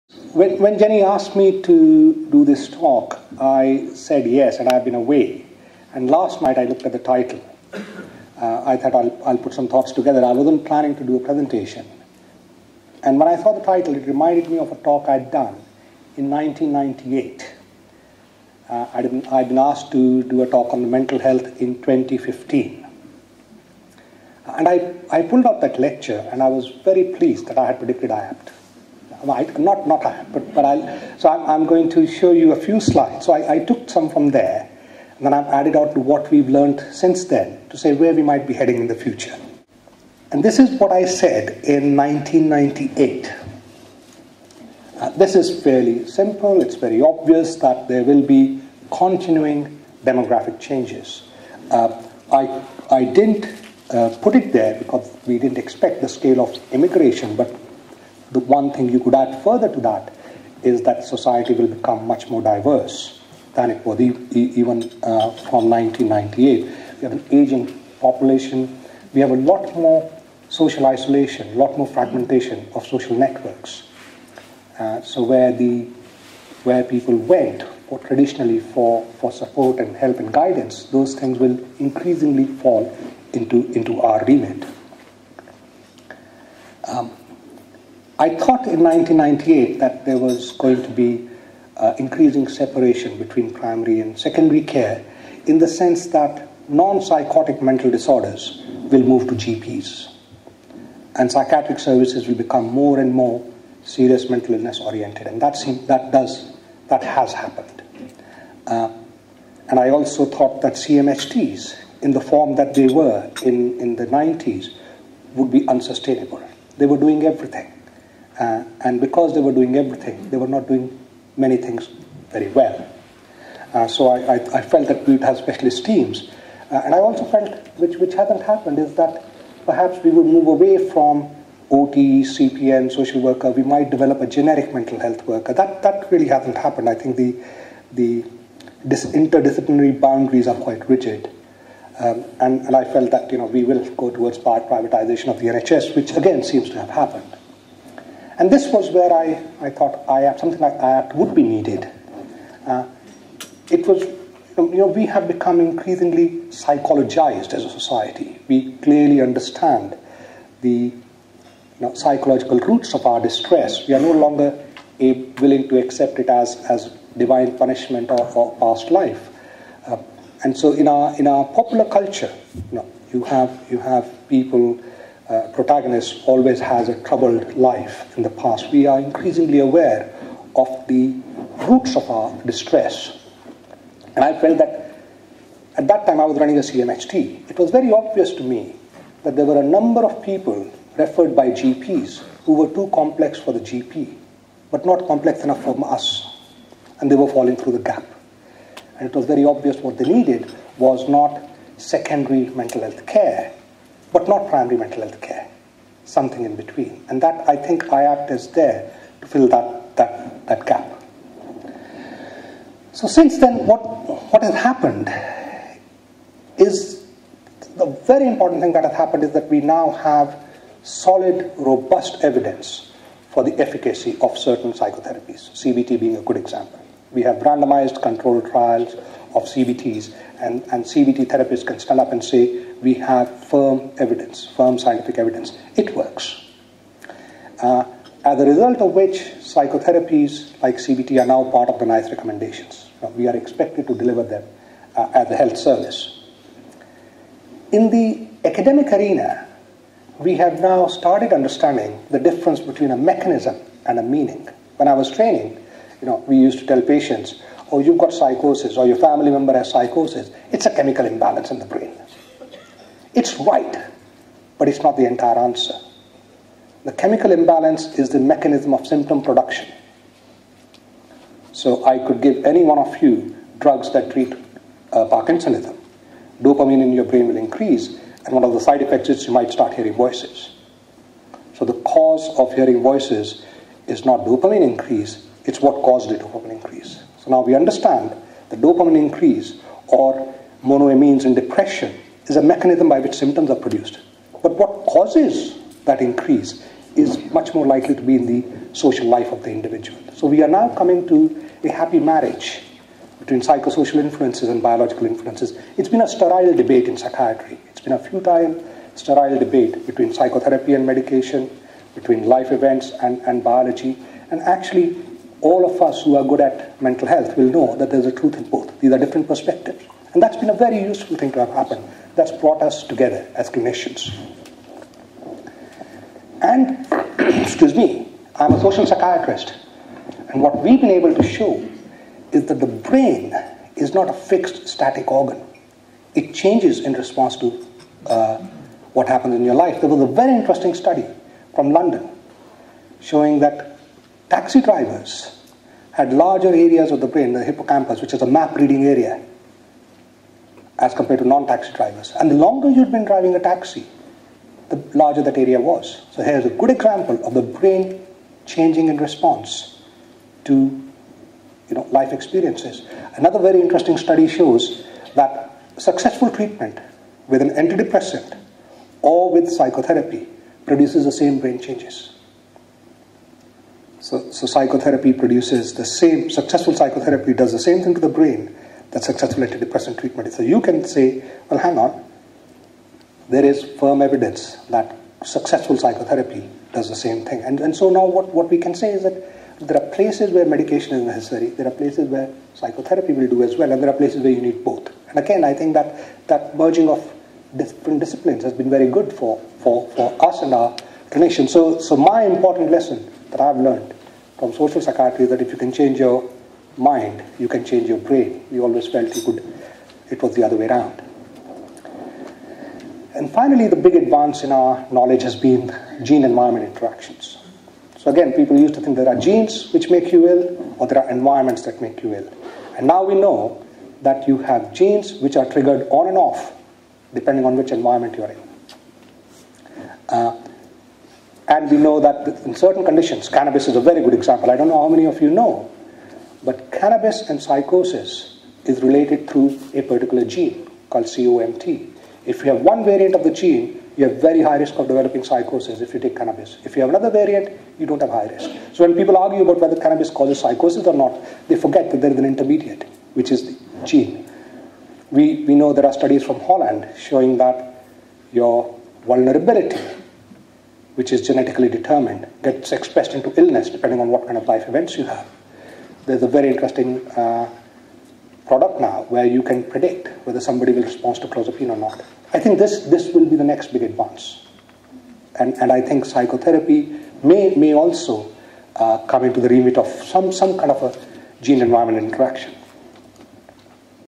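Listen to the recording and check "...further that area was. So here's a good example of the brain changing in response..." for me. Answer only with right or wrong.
wrong.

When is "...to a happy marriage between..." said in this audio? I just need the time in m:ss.
5:01.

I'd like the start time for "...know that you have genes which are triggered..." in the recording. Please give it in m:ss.
7:03.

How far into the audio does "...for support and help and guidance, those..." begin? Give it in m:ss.
1:19.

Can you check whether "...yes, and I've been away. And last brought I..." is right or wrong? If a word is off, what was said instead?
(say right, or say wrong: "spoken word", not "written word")
wrong: "night", not "brought".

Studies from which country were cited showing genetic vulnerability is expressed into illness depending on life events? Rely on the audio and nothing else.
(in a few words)
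Holland.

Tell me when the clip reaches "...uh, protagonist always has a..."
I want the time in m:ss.
2:55.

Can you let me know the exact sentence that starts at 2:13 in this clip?
We might develop a generic mental health worker.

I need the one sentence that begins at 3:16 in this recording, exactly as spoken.
And they were falling through the gap.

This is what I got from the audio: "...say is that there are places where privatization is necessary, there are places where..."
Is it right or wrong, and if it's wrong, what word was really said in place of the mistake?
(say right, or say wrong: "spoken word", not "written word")
wrong: "medication", not "privatization".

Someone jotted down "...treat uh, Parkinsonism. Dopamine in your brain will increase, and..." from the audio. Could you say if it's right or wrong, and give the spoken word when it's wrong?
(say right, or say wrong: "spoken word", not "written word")
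right.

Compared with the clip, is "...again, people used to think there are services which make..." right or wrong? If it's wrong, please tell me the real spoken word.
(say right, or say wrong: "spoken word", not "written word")
wrong: "genes", not "services".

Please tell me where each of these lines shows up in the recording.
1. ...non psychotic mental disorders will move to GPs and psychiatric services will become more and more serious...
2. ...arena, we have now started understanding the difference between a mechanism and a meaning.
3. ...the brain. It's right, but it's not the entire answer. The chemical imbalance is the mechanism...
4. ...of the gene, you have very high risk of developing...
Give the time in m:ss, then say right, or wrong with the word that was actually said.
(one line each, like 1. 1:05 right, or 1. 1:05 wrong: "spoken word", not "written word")
1. 1:36 right
2. 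4:08 right
3. 4:21 right
4. 7:23 right.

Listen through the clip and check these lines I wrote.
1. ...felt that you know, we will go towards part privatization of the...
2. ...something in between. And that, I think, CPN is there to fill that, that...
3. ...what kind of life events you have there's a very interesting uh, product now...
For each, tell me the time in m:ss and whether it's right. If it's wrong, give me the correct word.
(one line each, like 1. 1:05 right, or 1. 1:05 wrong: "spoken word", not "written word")
1. 2:22 right
2. 3:26 wrong: "IAPT", not "CPN"
3. 7:44 right.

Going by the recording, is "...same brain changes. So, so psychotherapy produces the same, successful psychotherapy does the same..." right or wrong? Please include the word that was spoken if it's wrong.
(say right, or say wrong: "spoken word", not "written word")
right.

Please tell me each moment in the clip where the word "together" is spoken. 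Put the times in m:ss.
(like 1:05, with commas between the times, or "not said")
0:09, 5:22.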